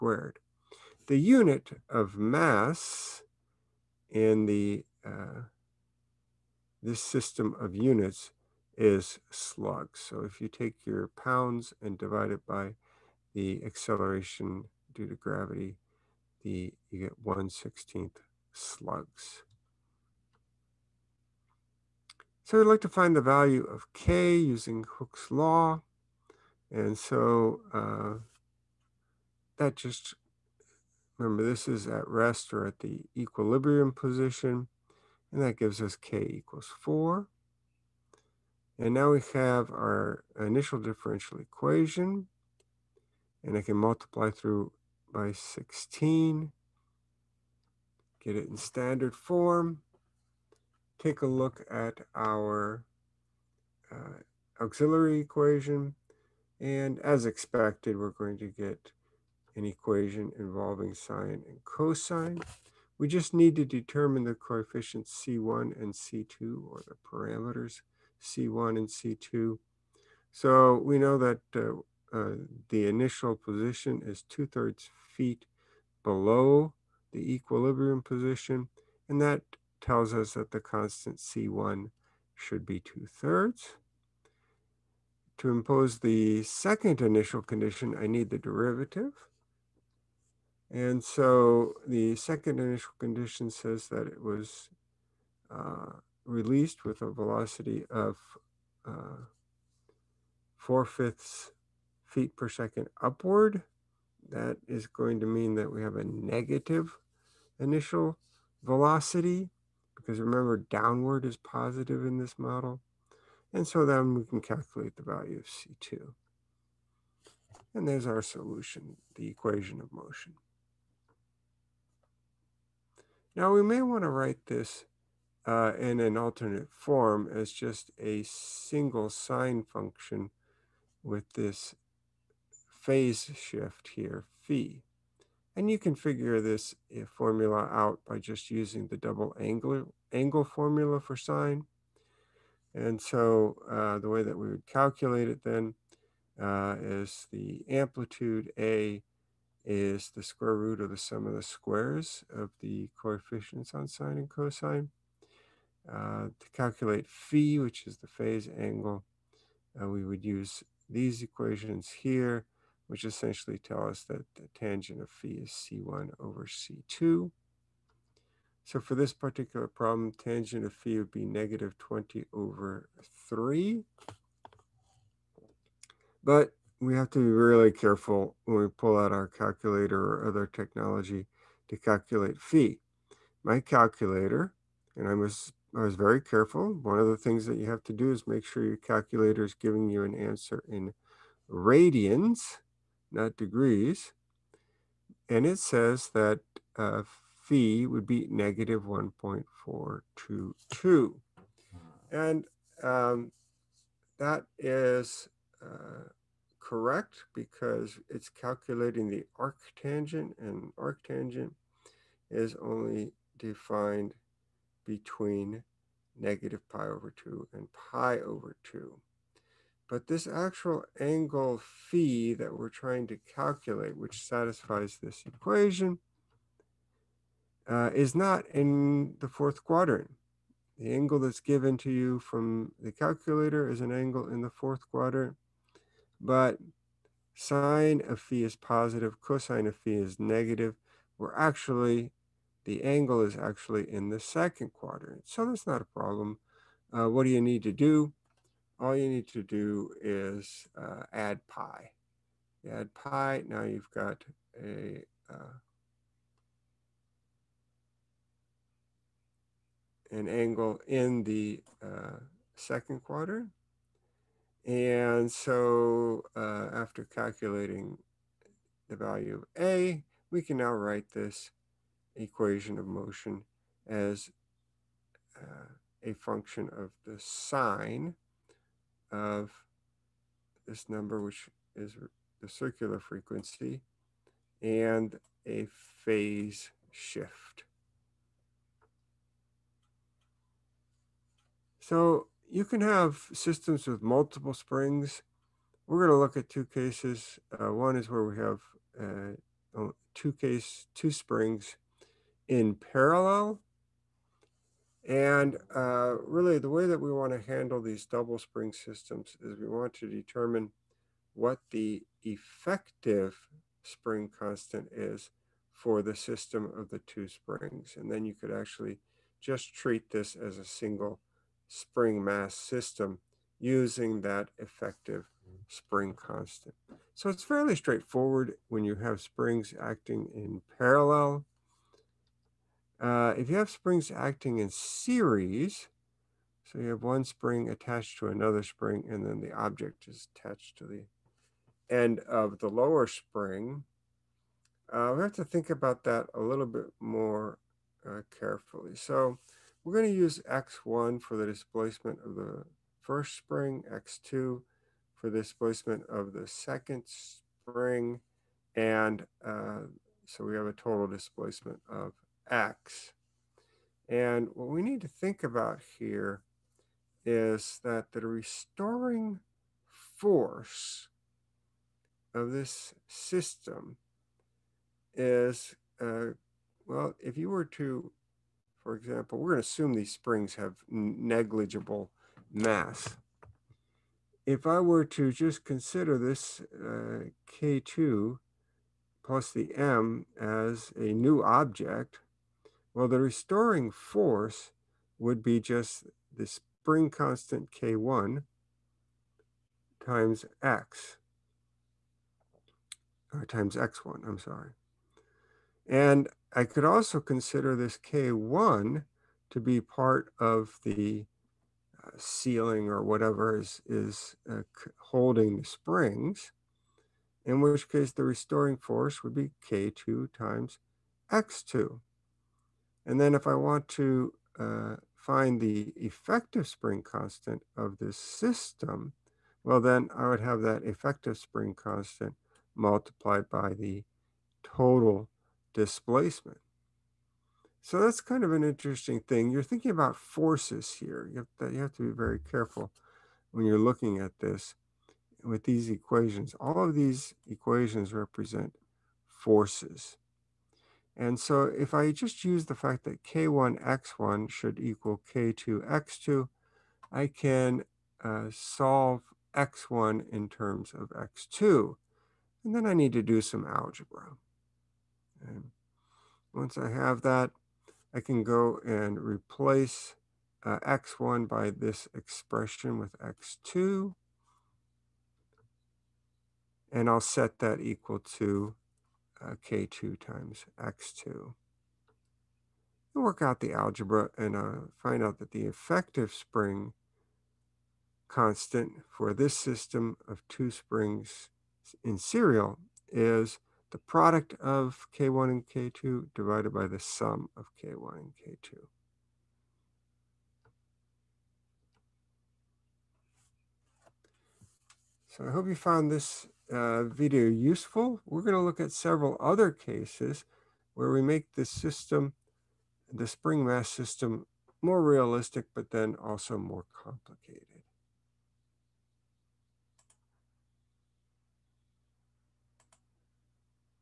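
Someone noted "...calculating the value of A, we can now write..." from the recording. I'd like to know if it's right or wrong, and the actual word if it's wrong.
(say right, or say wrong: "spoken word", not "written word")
right.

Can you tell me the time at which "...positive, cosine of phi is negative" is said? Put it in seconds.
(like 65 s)
238 s.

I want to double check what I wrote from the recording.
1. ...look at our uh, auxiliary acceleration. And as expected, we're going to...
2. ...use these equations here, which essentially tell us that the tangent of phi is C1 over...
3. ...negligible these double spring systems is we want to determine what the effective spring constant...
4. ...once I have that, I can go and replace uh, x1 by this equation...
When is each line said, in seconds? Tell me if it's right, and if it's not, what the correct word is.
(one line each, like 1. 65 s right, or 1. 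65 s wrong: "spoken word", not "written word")
1. 51 s wrong: "equation", not "acceleration"
2. 160 s right
3. 307 s wrong: "handle", not "negligible"
4. 466 s wrong: "expression", not "equation".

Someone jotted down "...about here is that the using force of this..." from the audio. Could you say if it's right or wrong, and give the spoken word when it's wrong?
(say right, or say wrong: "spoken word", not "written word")
wrong: "restoring", not "using".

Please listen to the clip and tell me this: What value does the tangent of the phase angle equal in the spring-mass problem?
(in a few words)
-20/3.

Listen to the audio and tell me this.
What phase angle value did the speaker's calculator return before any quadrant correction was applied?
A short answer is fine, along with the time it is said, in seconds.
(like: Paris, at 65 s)
-1.422, at 198 s.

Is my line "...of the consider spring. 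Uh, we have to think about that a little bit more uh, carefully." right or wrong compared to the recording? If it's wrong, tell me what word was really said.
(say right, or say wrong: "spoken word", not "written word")
wrong: "lower", not "consider".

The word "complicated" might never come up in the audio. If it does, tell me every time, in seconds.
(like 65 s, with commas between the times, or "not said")
516 s.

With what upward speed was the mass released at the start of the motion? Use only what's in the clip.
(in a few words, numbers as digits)
4/5 feet per second.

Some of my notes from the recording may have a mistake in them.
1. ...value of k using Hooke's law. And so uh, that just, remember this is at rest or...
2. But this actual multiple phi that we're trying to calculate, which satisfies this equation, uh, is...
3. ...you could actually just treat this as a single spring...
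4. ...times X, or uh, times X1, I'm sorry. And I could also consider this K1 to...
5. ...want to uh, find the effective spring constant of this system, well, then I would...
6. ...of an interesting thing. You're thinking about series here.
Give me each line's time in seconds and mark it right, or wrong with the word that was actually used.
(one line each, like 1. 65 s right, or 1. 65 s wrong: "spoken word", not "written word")
1. 23 s right
2. 219 s wrong: "angle", not "multiple"
3. 318 s right
4. 400 s right
5. 423 s right
6. 438 s wrong: "forces", not "series".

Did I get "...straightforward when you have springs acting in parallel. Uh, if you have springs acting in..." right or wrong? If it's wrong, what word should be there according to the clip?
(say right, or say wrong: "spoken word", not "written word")
right.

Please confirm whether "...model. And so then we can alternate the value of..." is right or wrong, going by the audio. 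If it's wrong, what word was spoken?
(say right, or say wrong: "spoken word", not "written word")
wrong: "calculate", not "alternate".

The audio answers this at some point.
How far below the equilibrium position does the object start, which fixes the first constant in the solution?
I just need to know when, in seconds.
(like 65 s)
74 s.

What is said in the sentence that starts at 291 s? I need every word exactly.
So you can have systems with multiple springs.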